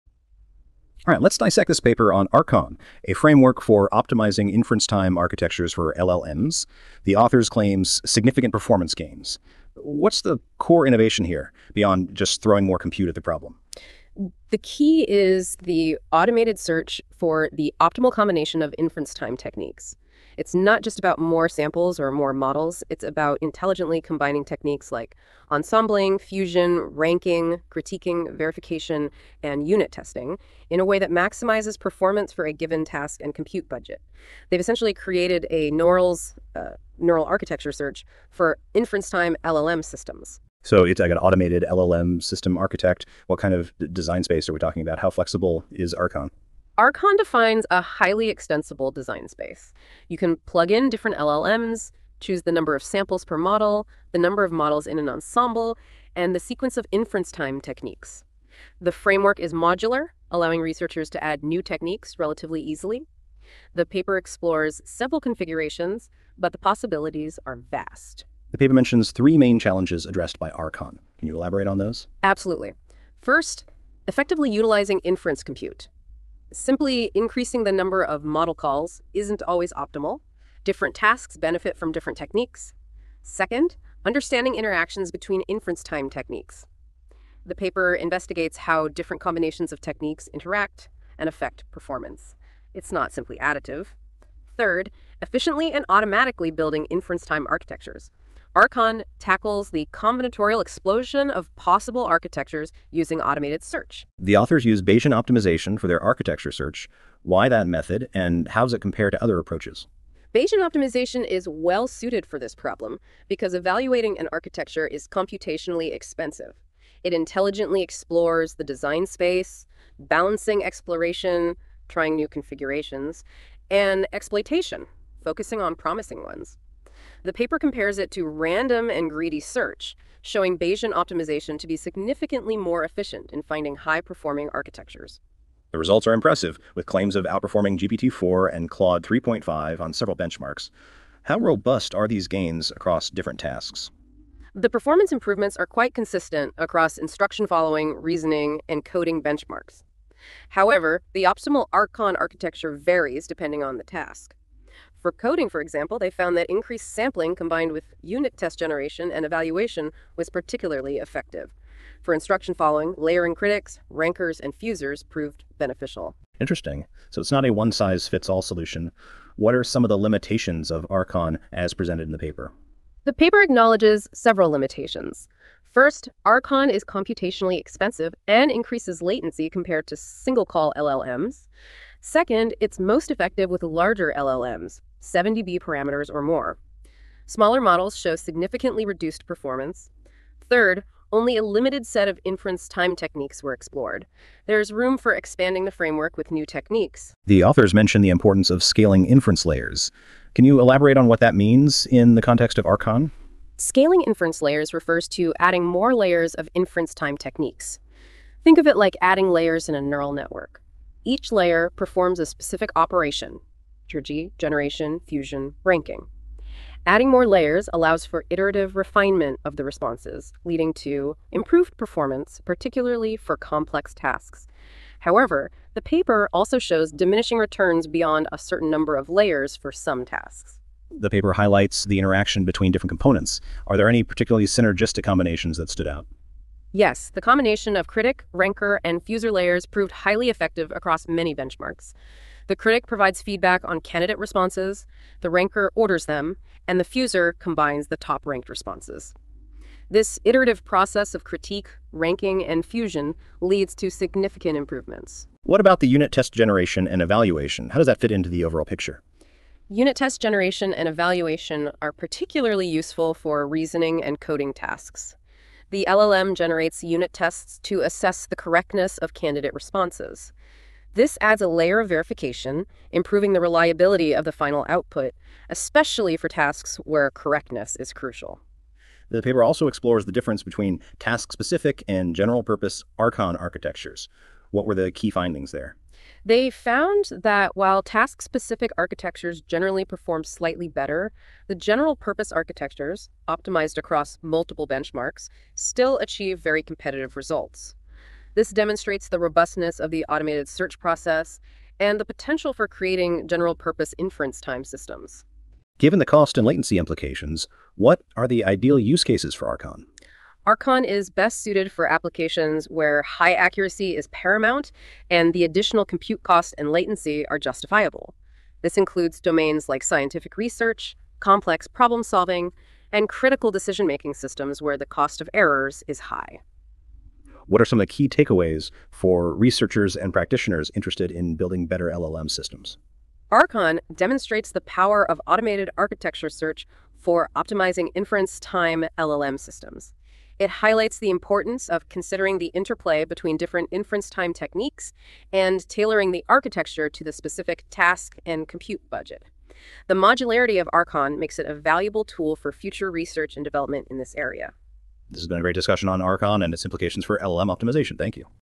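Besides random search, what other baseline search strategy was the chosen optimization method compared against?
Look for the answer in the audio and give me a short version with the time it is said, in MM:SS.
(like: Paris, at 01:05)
greedy search, at 02:09.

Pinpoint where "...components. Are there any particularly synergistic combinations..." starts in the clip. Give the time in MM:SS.
03:52.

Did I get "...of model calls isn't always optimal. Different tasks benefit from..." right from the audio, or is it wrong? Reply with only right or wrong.
right.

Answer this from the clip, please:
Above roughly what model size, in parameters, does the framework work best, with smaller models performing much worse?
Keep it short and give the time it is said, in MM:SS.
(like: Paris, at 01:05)
70B, at 03:05.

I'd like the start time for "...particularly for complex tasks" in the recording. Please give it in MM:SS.
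03:42.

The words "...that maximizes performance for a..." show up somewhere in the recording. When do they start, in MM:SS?
00:30.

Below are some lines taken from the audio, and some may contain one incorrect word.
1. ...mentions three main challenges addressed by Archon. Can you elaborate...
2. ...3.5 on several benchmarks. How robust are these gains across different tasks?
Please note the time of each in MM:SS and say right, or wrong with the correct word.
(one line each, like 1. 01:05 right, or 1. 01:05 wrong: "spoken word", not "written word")
1. 01:08 right
2. 02:19 right.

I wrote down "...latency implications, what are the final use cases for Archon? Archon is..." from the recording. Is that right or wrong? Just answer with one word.
wrong.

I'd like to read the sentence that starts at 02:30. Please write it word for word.
However, the optimal Archon architecture varies depending on the task.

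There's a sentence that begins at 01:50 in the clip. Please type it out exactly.
Bayesian optimization is well suited for this problem because evaluating an architecture is computationally expensive.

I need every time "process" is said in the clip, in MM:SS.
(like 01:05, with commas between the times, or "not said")
04:10, 05:00.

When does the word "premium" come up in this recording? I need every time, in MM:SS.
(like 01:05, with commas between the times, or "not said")
not said.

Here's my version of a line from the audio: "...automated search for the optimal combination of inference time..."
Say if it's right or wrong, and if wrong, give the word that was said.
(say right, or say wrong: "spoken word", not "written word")
right.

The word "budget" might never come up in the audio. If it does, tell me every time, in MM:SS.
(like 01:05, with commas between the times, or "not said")
00:33, 05:48.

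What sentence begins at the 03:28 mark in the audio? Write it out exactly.
Think of it like adding layers in a neural network.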